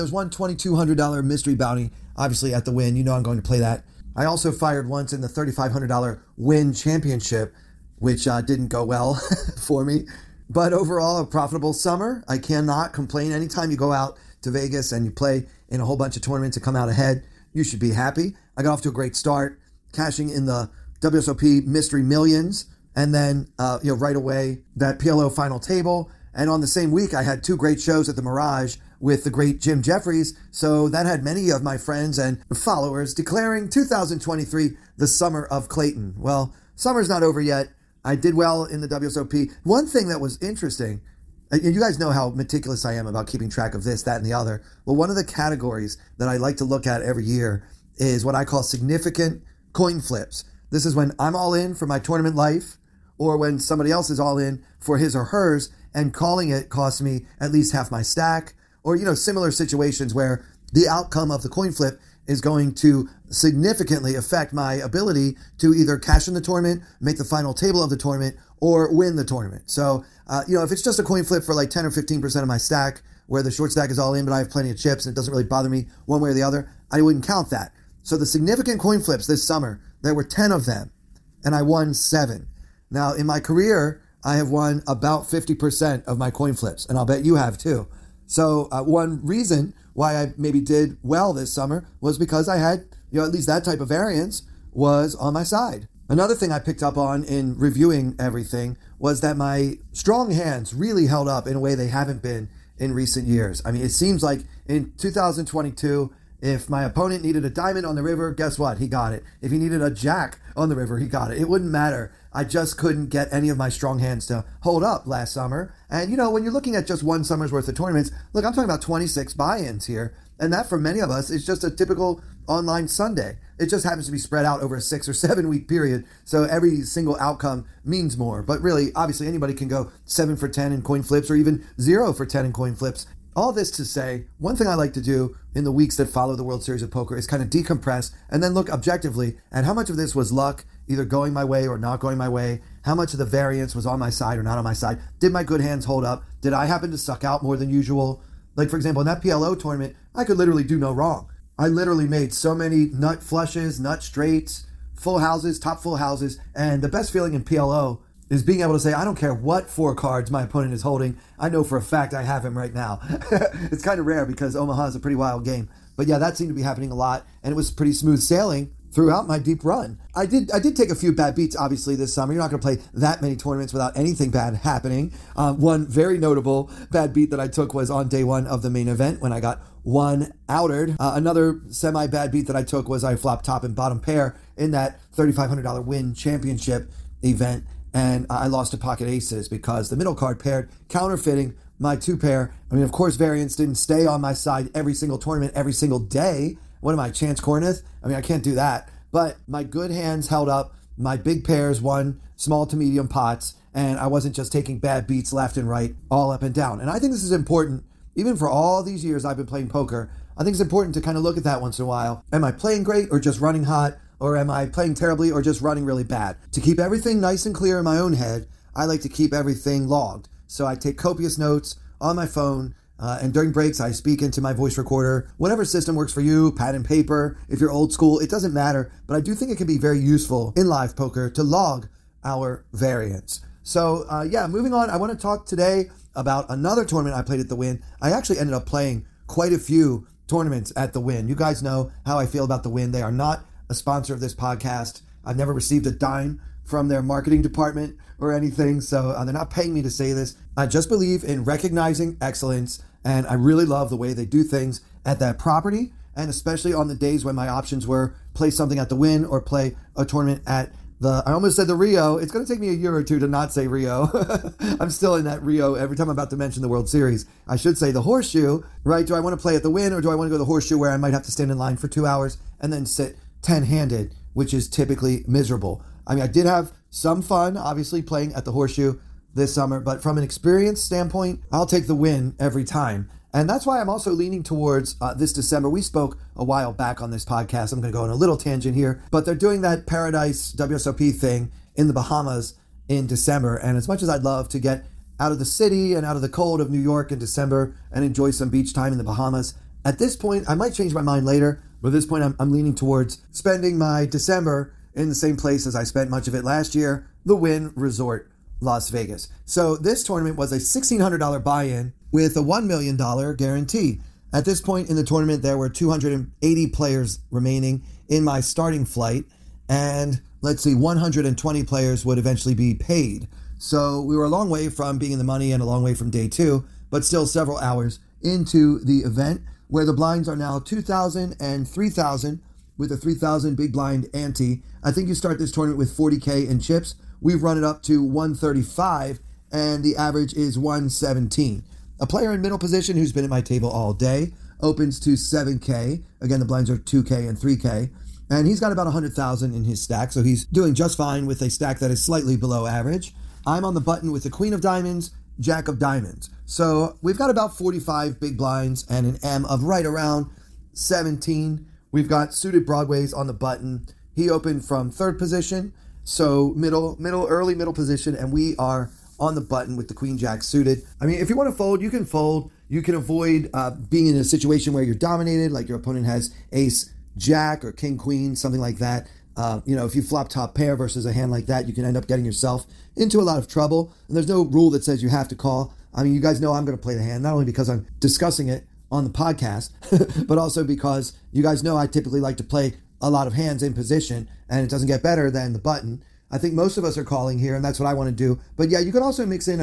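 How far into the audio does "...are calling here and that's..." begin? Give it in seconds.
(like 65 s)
396 s.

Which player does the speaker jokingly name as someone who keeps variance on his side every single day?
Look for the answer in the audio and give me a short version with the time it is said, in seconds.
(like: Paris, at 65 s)
Chance Kornuth, at 197 s.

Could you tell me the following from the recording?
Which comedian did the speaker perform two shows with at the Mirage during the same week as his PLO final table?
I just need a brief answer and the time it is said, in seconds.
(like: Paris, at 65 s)
Jim Jefferies, at 29 s.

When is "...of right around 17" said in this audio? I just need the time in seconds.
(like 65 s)
359 s.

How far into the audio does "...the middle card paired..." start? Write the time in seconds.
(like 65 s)
189 s.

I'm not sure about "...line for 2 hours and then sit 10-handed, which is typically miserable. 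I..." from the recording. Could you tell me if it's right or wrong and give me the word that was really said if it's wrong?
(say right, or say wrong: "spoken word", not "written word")
right.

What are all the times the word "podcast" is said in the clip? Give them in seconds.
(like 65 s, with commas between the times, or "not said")
244 s, 287 s, 389 s.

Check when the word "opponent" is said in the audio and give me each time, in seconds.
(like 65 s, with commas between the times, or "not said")
106 s, 160 s, 375 s.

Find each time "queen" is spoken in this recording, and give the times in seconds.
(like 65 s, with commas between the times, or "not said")
354 s, 369 s, 377 s.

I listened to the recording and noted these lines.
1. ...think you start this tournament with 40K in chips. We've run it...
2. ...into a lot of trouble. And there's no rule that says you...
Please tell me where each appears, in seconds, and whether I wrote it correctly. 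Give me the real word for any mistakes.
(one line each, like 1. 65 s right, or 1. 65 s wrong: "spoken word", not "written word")
1. 334 s right
2. 382 s right.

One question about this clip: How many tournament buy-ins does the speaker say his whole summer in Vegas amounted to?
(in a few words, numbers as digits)
26.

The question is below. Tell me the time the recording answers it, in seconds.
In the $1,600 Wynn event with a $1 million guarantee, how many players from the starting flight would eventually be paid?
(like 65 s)
320 s.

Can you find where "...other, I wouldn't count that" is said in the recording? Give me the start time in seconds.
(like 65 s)
76 s.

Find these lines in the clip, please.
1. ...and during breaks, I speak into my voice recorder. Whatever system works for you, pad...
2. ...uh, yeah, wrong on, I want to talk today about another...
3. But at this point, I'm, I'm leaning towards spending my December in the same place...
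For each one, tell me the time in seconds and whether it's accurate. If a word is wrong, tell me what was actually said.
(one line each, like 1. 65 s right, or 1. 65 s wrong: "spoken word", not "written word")
1. 223 s right
2. 234 s wrong: "moving", not "wrong"
3. 301 s right.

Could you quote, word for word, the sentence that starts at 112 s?
I just couldn't get any of my strong hands to hold up last summer.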